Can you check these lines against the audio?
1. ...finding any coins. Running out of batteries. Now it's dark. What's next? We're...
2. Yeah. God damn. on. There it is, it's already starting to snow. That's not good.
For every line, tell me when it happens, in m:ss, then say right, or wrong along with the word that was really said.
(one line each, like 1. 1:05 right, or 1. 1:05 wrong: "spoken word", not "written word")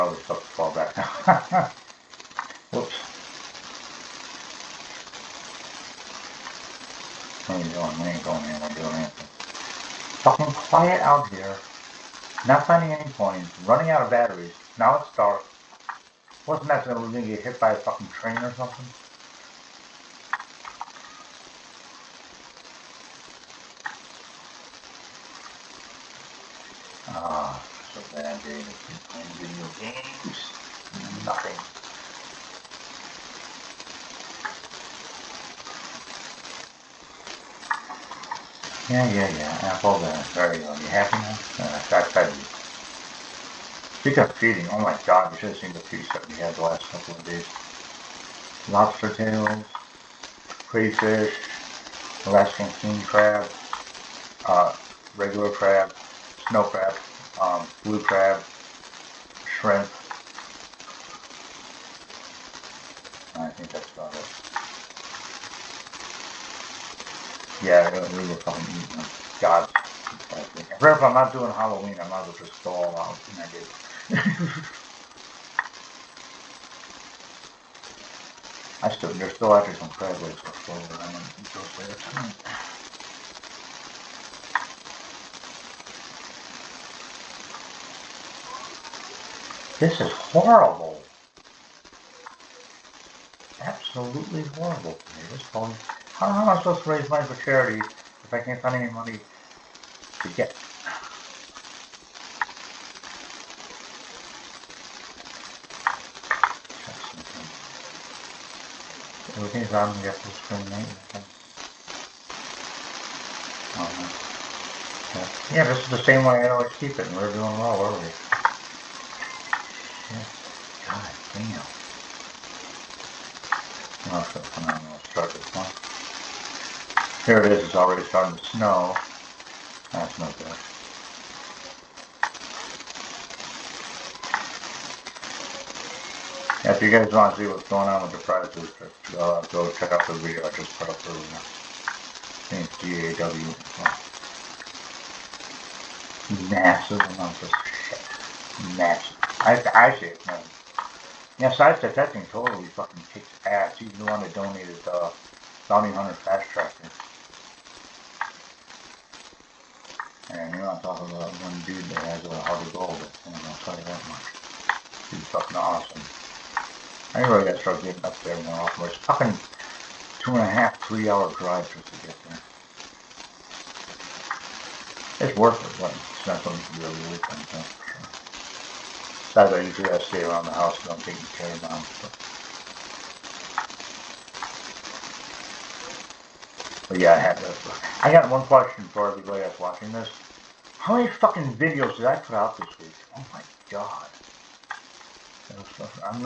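1. 0:12 right
2. 2:00 right.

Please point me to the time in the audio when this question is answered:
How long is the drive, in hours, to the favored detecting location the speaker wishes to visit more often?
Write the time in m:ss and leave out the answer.
2:50.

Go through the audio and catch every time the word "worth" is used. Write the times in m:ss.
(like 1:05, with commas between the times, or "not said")
2:55.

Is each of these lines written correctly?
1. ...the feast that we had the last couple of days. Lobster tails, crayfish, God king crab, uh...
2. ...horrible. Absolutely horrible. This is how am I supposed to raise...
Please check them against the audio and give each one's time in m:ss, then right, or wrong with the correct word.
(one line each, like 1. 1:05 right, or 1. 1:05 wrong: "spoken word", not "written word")
1. 0:45 wrong: "Alaskan", not "God"
2. 1:30 right.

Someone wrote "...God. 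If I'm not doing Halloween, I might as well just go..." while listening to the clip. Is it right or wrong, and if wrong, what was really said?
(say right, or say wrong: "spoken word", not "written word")
right.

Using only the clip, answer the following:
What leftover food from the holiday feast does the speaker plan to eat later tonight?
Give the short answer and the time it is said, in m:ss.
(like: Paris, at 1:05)
Crab legs, at 1:19.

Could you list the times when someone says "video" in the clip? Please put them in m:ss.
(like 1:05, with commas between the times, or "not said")
0:29, 2:20, 3:11.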